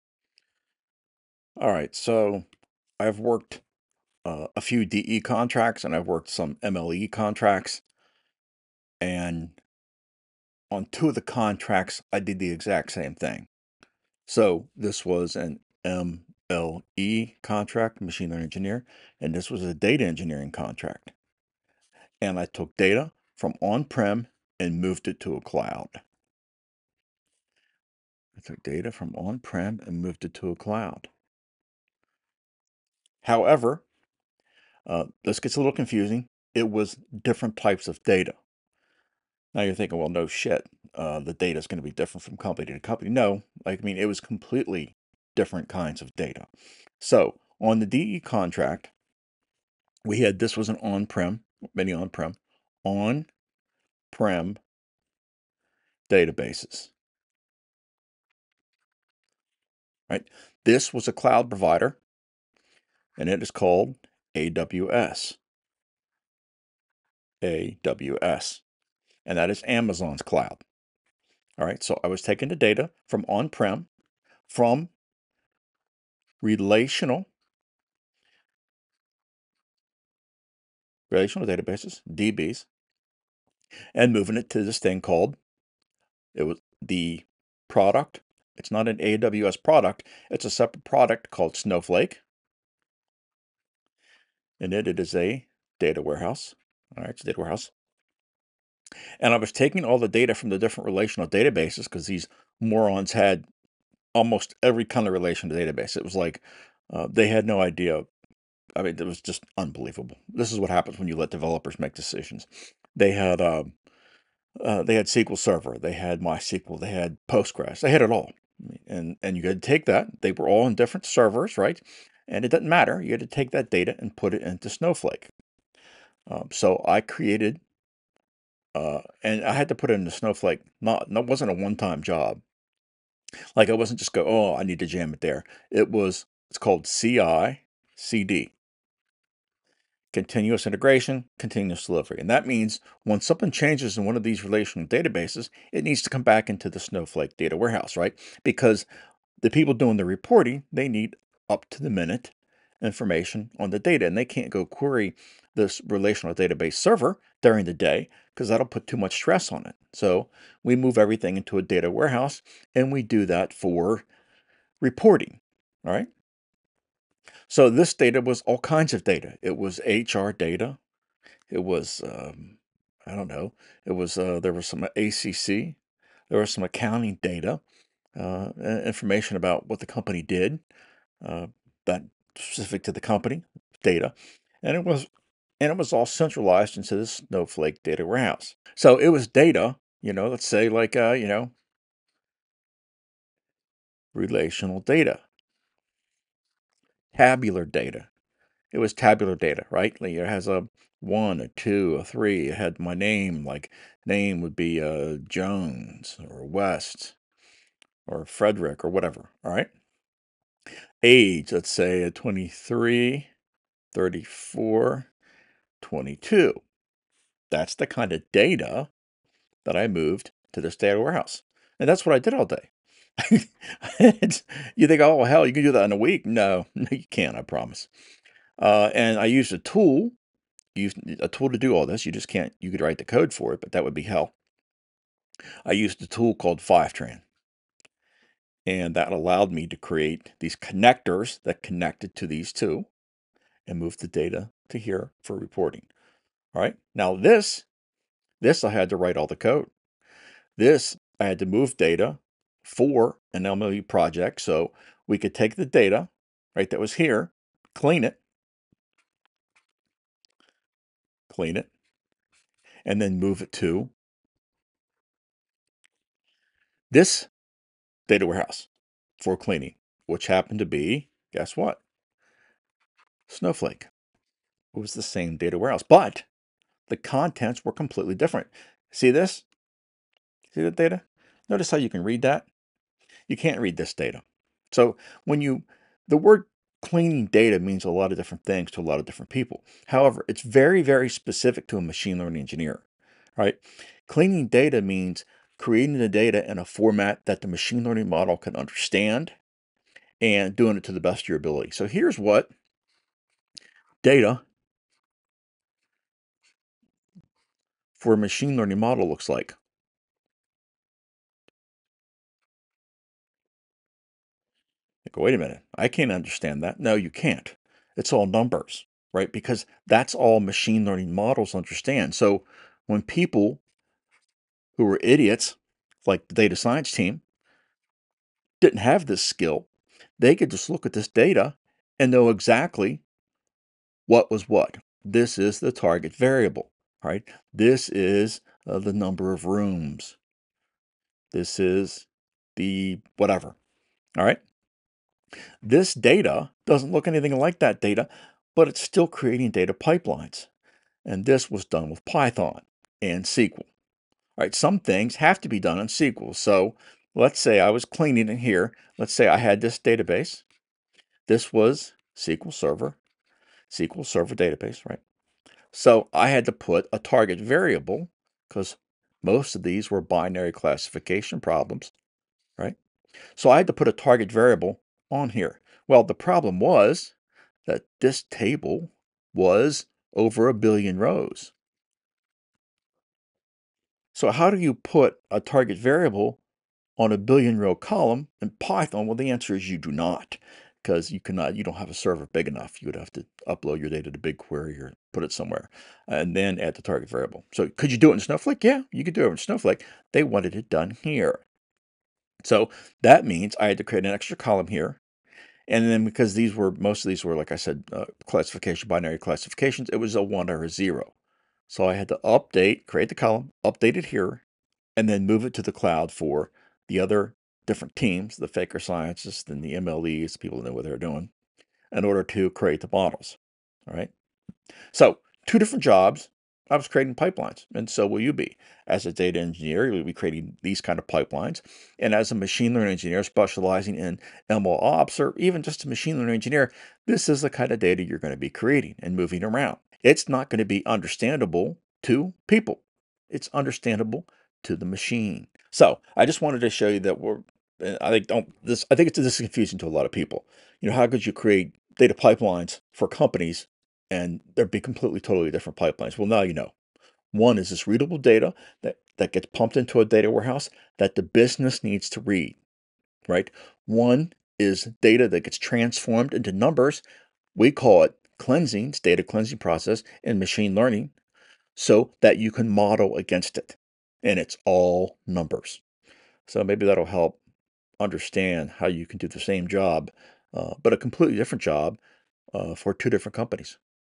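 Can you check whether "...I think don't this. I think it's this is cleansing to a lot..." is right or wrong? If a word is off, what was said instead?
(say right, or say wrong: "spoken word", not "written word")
wrong: "confusing", not "cleansing".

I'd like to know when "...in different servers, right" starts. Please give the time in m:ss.
2:00.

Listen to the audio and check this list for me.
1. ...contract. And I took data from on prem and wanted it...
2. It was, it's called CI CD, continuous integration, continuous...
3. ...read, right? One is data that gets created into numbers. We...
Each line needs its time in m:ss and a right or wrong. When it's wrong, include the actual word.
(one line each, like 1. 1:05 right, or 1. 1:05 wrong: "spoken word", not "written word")
1. 0:20 wrong: "moved", not "wanted"
2. 2:15 right
3. 7:42 wrong: "transformed", not "created".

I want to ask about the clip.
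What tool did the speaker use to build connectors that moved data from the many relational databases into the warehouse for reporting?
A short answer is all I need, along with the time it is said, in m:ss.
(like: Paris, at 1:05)
Fivetran, at 3:56.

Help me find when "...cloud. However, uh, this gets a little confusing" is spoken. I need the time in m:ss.
0:30.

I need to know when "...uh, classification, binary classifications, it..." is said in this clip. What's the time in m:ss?
6:47.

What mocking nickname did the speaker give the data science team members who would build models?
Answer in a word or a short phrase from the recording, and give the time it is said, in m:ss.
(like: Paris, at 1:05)
faker scientists, at 6:58.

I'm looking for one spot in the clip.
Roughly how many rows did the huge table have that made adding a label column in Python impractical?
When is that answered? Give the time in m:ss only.
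6:20.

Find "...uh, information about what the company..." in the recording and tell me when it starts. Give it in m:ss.
2:58.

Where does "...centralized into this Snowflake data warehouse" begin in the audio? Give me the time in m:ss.
3:06.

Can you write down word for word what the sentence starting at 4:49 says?
However, it's very, very specific to a machine learning engineer, right?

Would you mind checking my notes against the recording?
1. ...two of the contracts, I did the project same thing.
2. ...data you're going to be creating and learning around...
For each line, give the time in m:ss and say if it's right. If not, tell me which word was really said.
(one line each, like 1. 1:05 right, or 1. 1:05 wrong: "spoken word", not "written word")
1. 0:10 wrong: "exact", not "project"
2. 7:17 wrong: "moving", not "learning".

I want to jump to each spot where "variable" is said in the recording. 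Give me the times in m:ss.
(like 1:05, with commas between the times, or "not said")
5:36, 6:07, 6:14, 6:25, 6:37.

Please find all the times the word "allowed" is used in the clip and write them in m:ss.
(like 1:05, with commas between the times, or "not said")
3:59.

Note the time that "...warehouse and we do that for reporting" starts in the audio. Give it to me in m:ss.
2:41.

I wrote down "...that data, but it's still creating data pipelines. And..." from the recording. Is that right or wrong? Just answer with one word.
right.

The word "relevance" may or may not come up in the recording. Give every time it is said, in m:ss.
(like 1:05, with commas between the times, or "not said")
not said.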